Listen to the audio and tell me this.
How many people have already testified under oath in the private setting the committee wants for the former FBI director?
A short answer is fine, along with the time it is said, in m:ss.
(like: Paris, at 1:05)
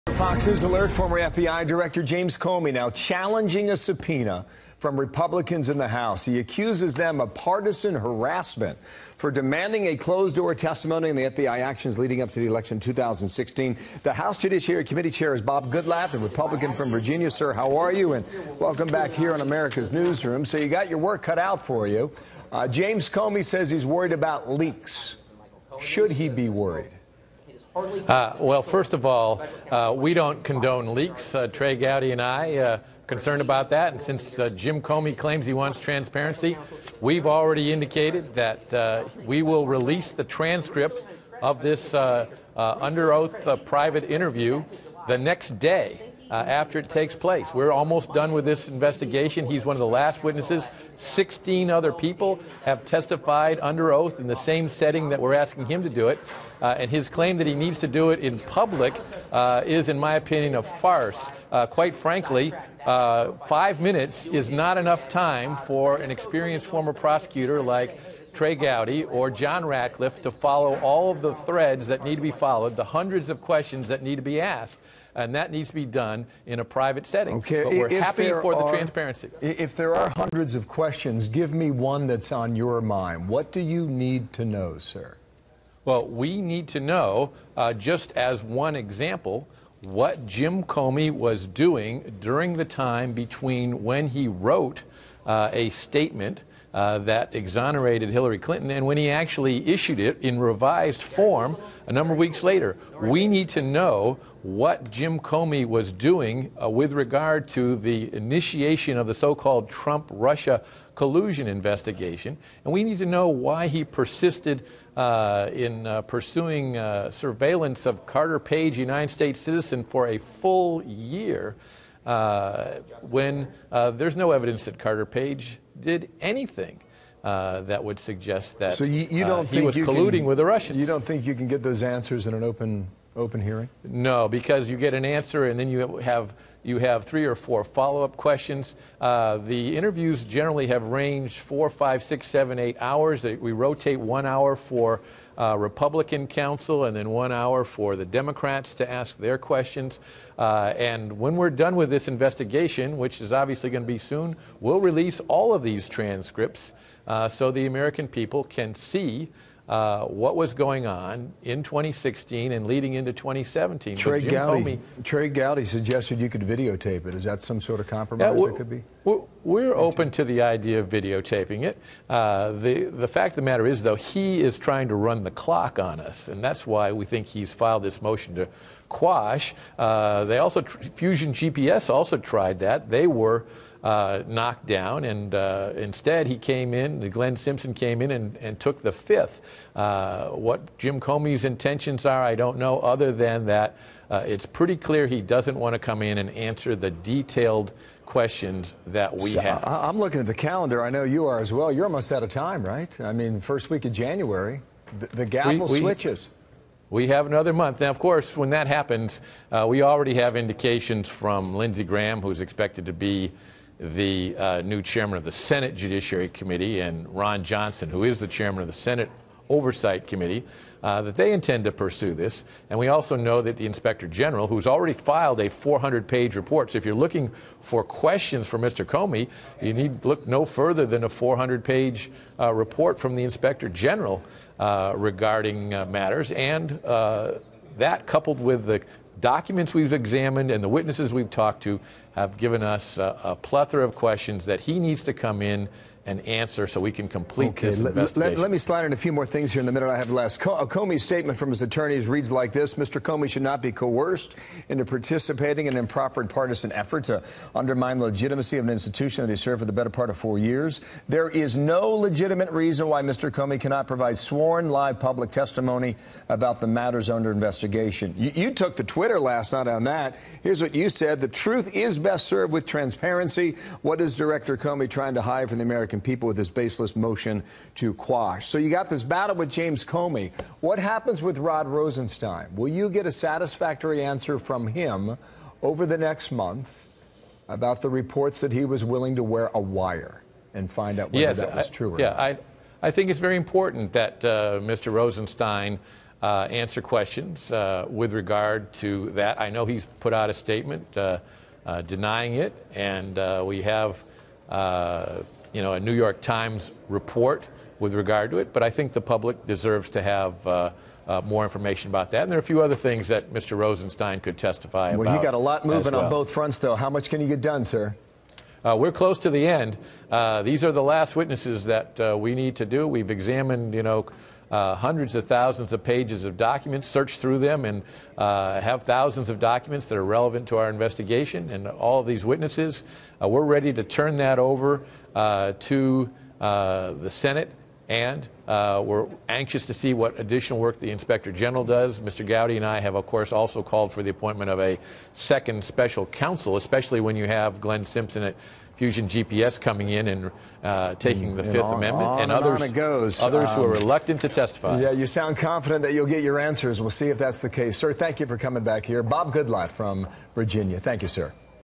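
16, at 0:50.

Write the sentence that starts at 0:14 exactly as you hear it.
The House Judiciary Committee Chair is Bob Goodlatte, the Republican from Virginia.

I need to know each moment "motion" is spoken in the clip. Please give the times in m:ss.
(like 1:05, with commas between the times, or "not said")
2:58, 4:36.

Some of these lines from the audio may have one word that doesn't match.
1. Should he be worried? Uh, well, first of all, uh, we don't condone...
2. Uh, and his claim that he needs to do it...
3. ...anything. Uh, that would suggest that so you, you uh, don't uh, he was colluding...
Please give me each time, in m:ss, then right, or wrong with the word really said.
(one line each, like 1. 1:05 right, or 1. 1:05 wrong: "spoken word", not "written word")
1. 0:25 right
2. 0:56 right
3. 2:06 right.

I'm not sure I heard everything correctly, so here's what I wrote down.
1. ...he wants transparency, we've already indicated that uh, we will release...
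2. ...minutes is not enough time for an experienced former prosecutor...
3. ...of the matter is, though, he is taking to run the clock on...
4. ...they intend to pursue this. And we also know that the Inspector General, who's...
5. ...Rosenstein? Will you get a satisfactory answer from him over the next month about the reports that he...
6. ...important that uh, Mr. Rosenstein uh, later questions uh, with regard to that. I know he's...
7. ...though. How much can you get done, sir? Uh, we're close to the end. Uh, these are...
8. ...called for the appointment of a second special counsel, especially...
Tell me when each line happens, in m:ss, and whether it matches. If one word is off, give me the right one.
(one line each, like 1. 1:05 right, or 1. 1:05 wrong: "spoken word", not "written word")
1. 0:35 right
2. 1:03 right
3. 2:53 wrong: "trying", not "taking"
4. 3:41 right
5. 4:41 right
6. 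4:53 wrong: "answer", not "later"
7. 5:16 right
8. 5:43 right.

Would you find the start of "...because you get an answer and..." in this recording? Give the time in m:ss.
2:14.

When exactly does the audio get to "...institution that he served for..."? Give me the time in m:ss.
4:18.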